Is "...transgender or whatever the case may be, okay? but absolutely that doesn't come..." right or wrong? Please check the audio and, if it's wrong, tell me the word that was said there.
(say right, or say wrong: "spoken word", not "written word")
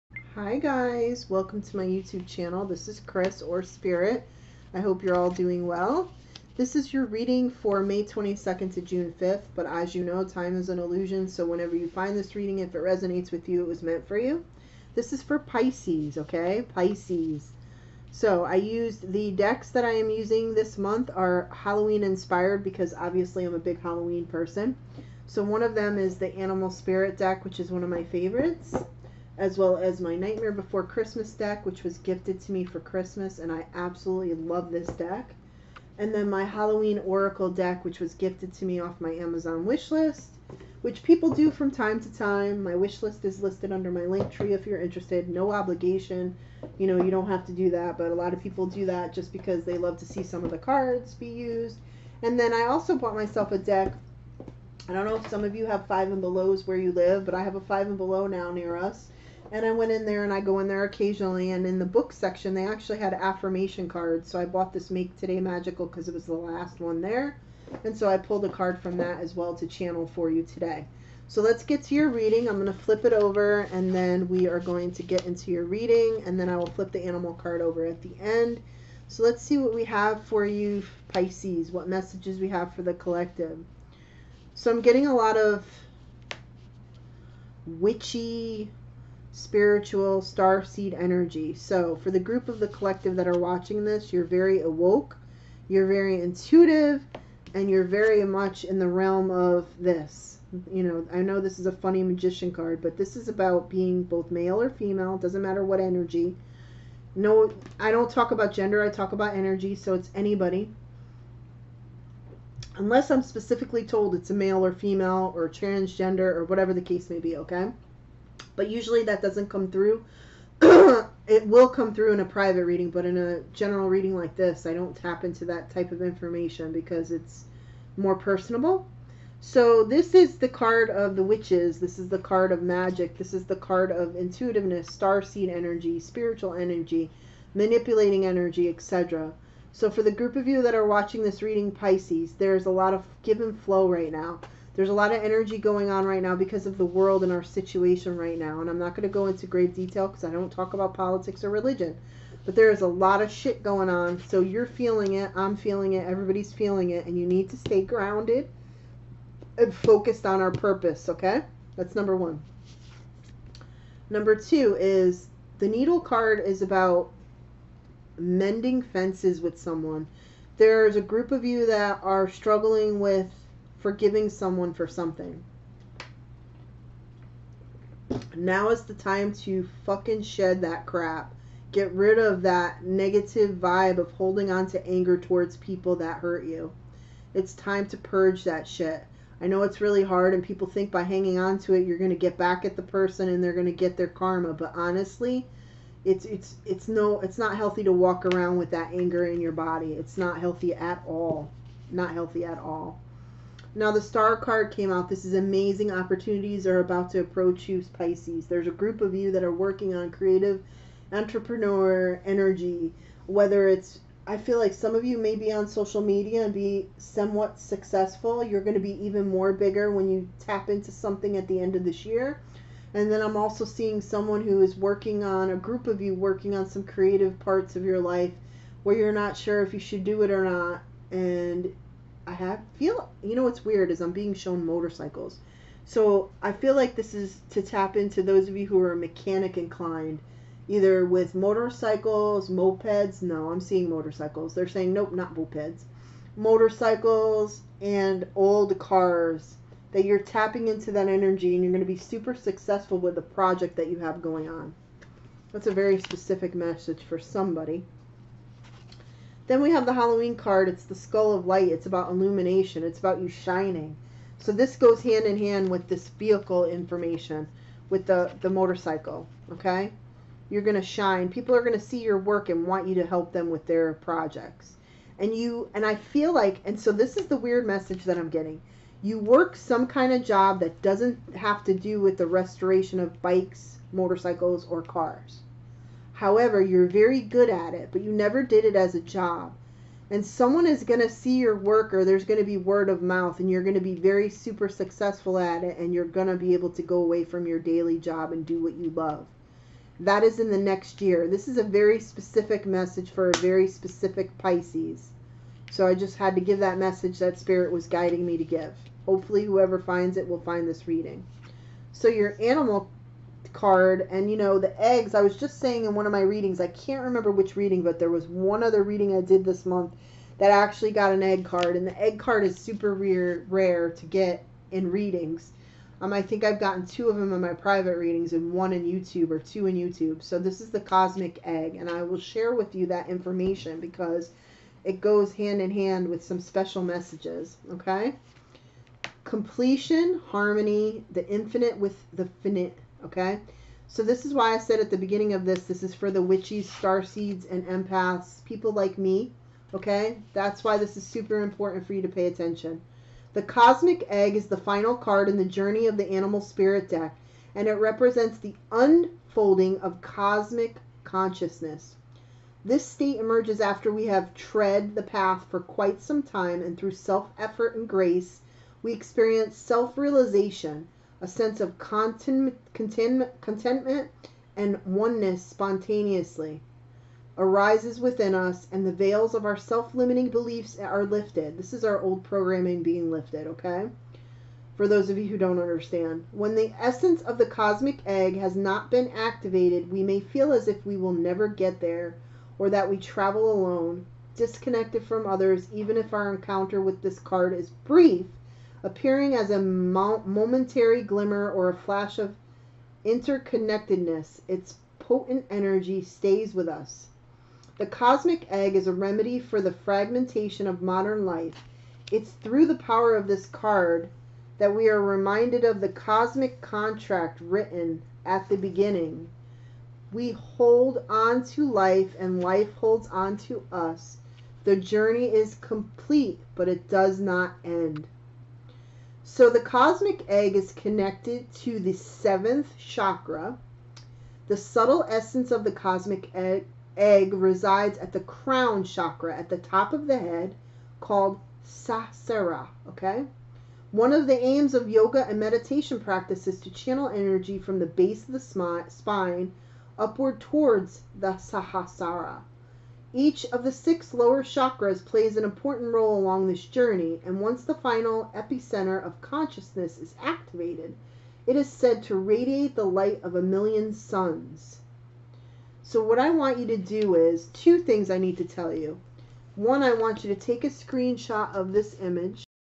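wrong: "usually", not "absolutely".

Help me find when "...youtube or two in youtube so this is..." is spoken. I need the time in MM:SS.
05:28.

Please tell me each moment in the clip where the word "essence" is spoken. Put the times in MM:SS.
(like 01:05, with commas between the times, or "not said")
06:26, 07:15.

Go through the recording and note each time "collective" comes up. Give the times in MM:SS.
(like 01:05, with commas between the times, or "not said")
01:22, 01:32.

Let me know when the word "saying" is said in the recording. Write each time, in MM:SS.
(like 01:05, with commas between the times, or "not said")
04:04, 05:15.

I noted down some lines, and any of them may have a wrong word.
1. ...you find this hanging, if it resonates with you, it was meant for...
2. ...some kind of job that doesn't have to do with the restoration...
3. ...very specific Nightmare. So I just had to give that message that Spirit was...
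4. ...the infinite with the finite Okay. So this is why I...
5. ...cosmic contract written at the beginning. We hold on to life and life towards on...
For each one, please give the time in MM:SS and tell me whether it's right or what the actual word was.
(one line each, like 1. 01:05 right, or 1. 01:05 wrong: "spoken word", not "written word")
1. 00:11 wrong: "reading", not "hanging"
2. 04:39 right
3. 05:03 wrong: "Pisces", not "Nightmare"
4. 05:41 right
5. 06:55 wrong: "holds", not "towards".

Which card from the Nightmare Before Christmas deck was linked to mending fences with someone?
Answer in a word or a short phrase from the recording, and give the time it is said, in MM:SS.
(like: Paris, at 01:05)
The needle card, at 02:45.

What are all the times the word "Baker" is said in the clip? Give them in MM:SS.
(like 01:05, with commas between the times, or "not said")
not said.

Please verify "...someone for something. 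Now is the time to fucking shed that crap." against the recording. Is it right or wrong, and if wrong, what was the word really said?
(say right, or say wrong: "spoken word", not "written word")
right.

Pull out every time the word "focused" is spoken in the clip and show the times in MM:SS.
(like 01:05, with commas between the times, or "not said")
02:39.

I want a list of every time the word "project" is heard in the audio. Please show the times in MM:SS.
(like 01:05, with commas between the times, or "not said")
04:13, 04:33.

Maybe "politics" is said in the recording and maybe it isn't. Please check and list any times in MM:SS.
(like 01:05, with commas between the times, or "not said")
02:30.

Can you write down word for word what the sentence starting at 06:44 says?
Its potent energy stays with us.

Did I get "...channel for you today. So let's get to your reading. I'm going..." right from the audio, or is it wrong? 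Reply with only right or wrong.
right.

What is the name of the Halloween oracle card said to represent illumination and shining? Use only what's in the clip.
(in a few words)
Skull of light.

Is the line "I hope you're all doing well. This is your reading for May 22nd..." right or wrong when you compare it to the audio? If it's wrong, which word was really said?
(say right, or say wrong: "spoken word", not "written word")
right.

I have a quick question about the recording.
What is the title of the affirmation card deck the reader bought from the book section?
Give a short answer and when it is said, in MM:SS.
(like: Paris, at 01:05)
Make Today Magical, at 01:04.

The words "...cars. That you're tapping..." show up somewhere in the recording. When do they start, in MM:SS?
04:08.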